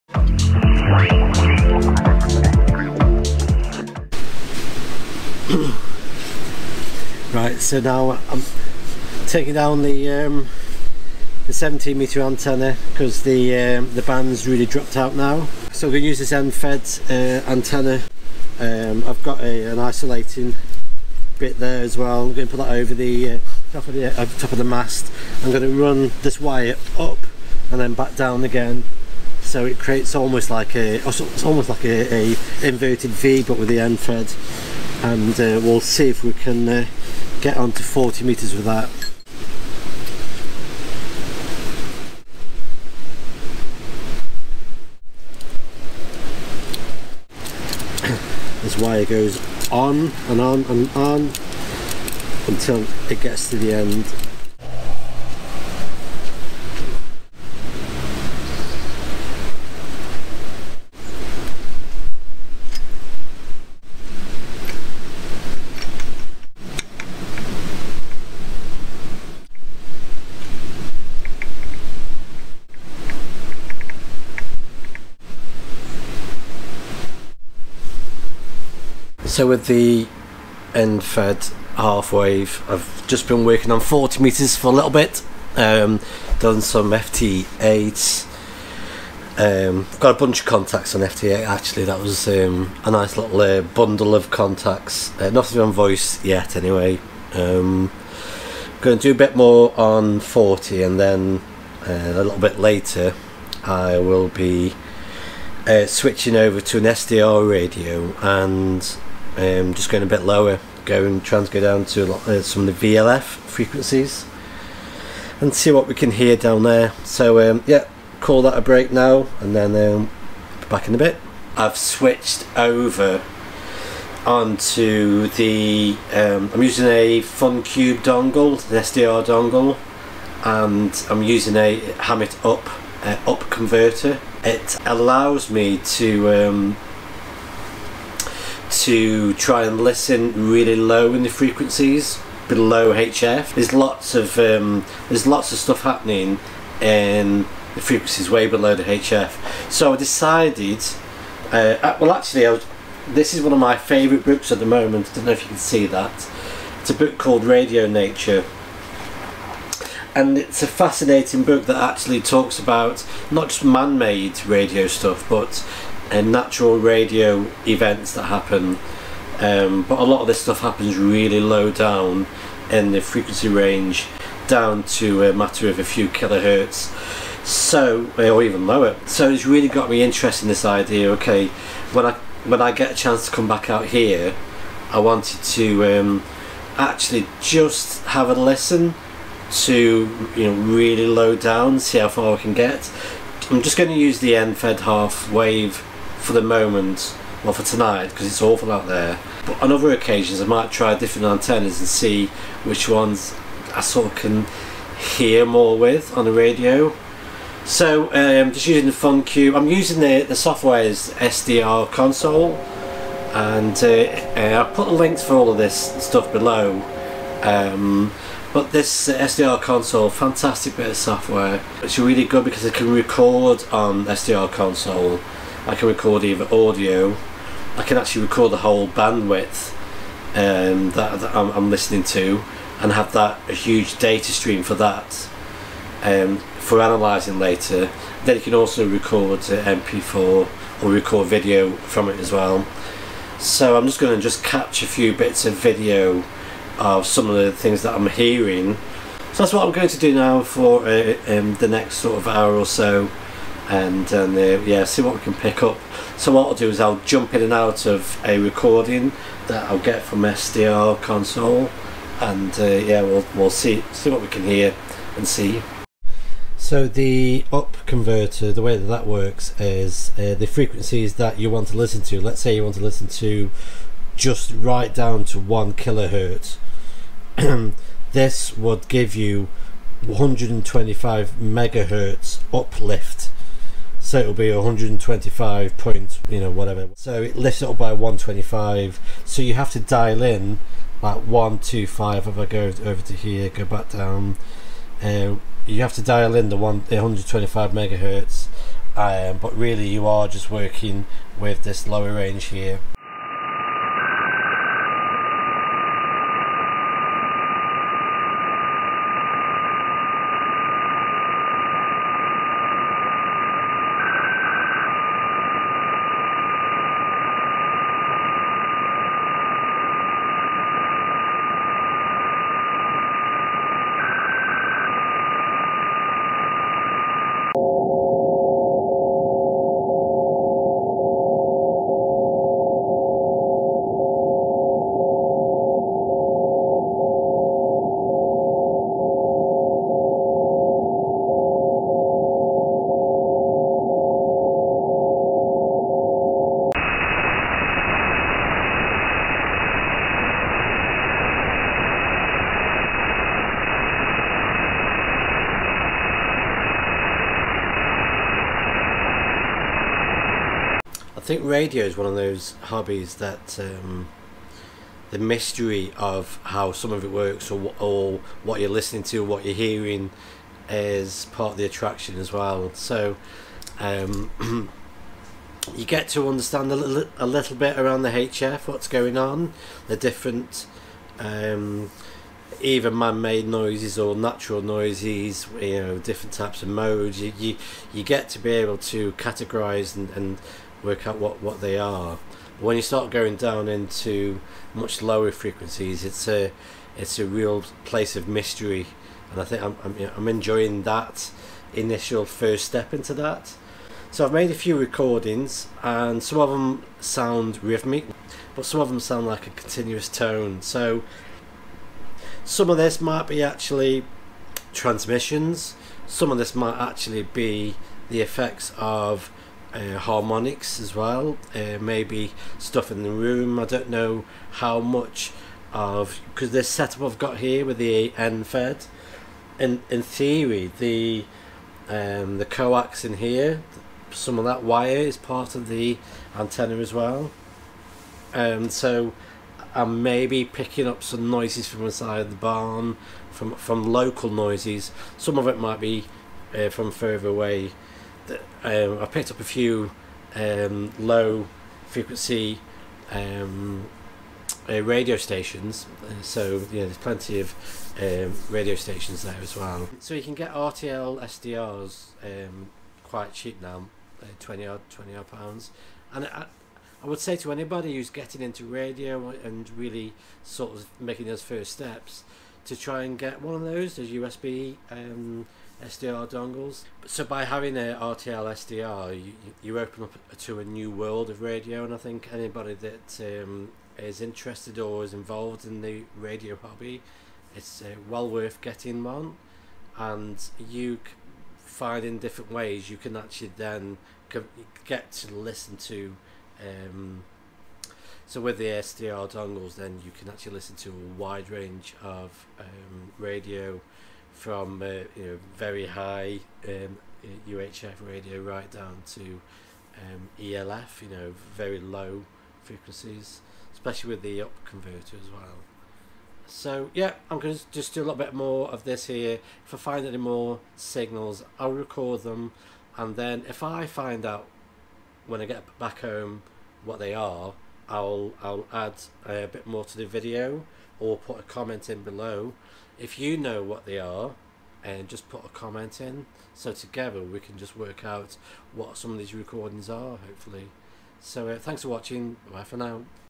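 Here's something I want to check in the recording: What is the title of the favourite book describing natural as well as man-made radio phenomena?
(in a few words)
Radio Nature.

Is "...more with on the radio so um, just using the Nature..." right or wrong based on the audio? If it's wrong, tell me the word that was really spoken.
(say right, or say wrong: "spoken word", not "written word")
wrong: "FunCube", not "Nature".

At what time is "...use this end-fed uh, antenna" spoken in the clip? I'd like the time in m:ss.
0:16.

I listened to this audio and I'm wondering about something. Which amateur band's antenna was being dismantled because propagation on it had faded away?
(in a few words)
17 meter.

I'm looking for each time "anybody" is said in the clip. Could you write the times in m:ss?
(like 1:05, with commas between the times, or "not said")
7:47, 8:02.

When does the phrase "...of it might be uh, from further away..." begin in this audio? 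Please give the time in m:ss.
7:25.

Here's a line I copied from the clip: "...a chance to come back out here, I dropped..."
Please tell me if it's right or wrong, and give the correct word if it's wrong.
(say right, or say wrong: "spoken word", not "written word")
wrong: "wanted", not "dropped".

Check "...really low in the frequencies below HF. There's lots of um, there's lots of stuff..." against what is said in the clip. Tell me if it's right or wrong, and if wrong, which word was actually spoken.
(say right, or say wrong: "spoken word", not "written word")
right.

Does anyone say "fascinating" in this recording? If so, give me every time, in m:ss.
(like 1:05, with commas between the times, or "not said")
2:40.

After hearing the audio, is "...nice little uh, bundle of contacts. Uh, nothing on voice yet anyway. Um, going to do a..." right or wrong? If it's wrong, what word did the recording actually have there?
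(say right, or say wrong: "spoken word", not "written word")
right.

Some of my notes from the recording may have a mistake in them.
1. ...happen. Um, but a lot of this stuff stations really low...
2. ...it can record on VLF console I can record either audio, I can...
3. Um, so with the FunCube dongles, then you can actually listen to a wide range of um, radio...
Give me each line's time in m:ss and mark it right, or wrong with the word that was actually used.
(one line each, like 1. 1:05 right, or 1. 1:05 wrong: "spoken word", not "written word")
1. 2:48 wrong: "happens", not "stations"
2. 3:42 wrong: "SDR", not "VLF"
3. 8:16 wrong: "SDR", not "FunCube".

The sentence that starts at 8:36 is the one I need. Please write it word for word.
So yeah, I'm going to just do a little bit more of this here.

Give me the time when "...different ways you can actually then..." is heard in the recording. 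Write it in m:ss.
8:12.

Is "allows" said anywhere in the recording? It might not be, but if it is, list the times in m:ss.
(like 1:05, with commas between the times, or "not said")
2:14.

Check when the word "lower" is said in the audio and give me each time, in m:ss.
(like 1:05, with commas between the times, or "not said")
1:50, 2:58, 5:01, 6:35.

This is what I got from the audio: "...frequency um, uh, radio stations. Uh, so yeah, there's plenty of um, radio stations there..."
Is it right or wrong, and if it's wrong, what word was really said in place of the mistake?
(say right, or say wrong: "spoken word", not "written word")
right.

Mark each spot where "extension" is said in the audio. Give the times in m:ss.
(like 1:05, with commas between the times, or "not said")
not said.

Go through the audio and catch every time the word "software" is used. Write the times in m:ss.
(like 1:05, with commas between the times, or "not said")
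3:30, 3:40.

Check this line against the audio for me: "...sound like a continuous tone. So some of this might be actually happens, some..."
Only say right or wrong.
wrong.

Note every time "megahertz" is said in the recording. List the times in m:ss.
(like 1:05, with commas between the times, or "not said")
4:41, 4:57.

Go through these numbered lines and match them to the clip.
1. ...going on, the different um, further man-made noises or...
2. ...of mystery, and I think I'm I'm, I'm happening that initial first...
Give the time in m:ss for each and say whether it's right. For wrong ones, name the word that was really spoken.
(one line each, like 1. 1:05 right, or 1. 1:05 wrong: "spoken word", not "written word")
1. 6:18 wrong: "either", not "further"
2. 6:38 wrong: "enjoying", not "happening".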